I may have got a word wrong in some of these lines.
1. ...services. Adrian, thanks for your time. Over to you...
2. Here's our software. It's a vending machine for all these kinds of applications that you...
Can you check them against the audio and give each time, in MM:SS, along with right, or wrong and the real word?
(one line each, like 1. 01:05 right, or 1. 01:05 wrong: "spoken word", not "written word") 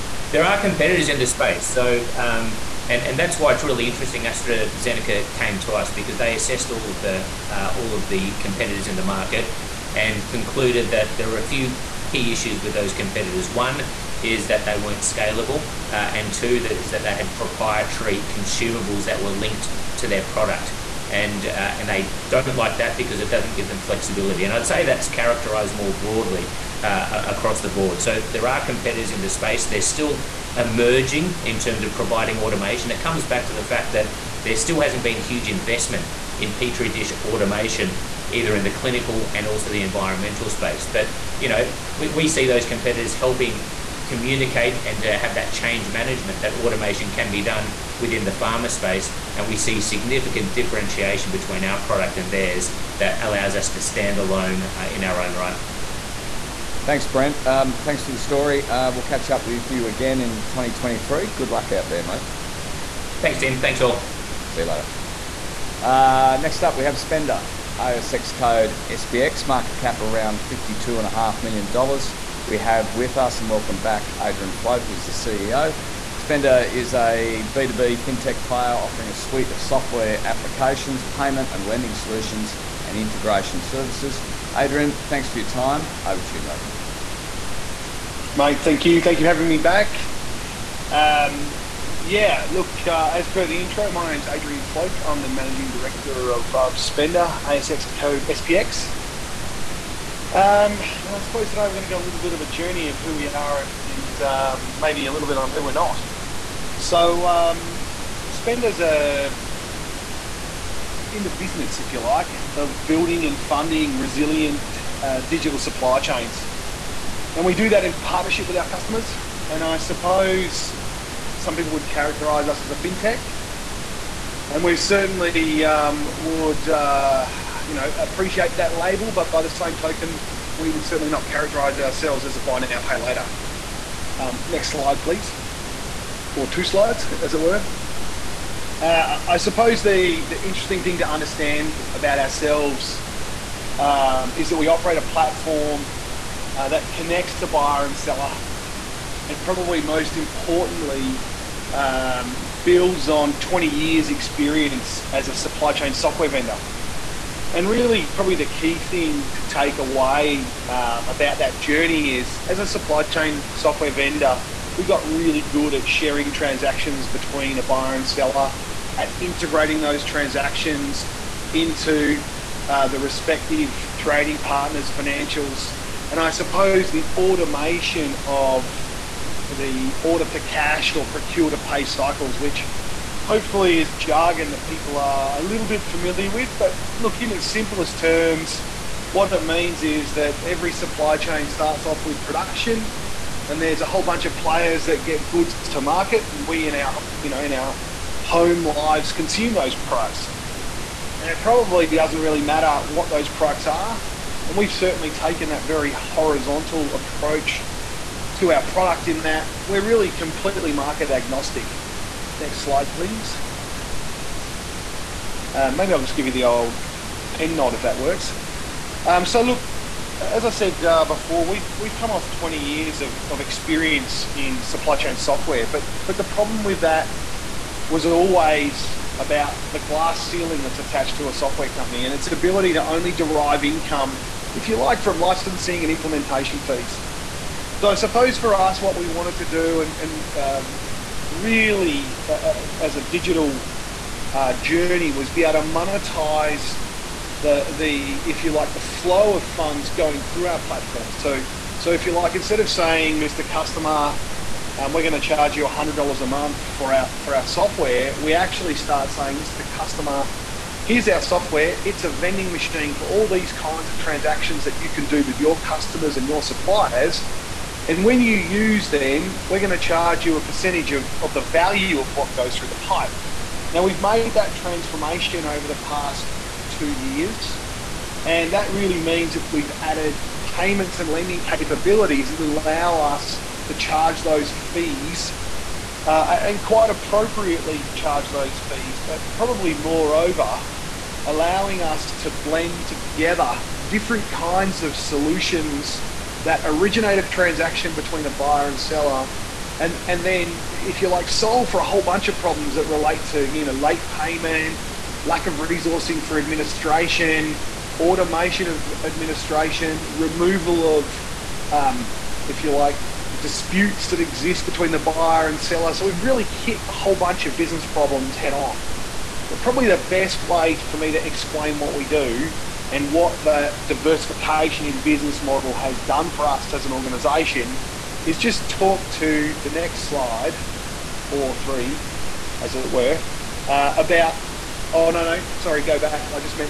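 1. 01:23 right
2. 04:20 wrong: "transactions", not "applications".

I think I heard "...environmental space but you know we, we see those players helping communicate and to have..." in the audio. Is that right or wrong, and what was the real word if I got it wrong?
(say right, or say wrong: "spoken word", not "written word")
wrong: "competitors", not "players".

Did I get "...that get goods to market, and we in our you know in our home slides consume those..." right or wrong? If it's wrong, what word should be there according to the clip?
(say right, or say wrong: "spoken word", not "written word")
wrong: "lives", not "slides".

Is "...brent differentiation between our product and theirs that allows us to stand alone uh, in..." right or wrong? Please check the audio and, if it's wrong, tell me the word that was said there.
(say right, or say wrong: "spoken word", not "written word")
wrong: "significant", not "brent".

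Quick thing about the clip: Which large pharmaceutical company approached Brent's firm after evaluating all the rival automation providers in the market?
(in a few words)
AstraZeneca.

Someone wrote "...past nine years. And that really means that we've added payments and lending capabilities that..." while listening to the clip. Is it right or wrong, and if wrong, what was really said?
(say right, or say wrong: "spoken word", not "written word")
wrong: "two", not "nine".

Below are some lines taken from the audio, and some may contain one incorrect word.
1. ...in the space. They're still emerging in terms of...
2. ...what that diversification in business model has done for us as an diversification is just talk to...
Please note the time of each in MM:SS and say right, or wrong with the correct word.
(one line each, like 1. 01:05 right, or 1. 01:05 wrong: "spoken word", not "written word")
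1. 00:29 right
2. 05:23 wrong: "organization", not "diversification".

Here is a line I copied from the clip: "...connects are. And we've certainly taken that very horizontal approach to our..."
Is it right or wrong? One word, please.
wrong.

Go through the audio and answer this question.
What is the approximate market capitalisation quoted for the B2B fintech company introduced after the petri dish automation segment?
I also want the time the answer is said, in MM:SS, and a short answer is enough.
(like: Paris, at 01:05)
$52.5 million, at 01:10.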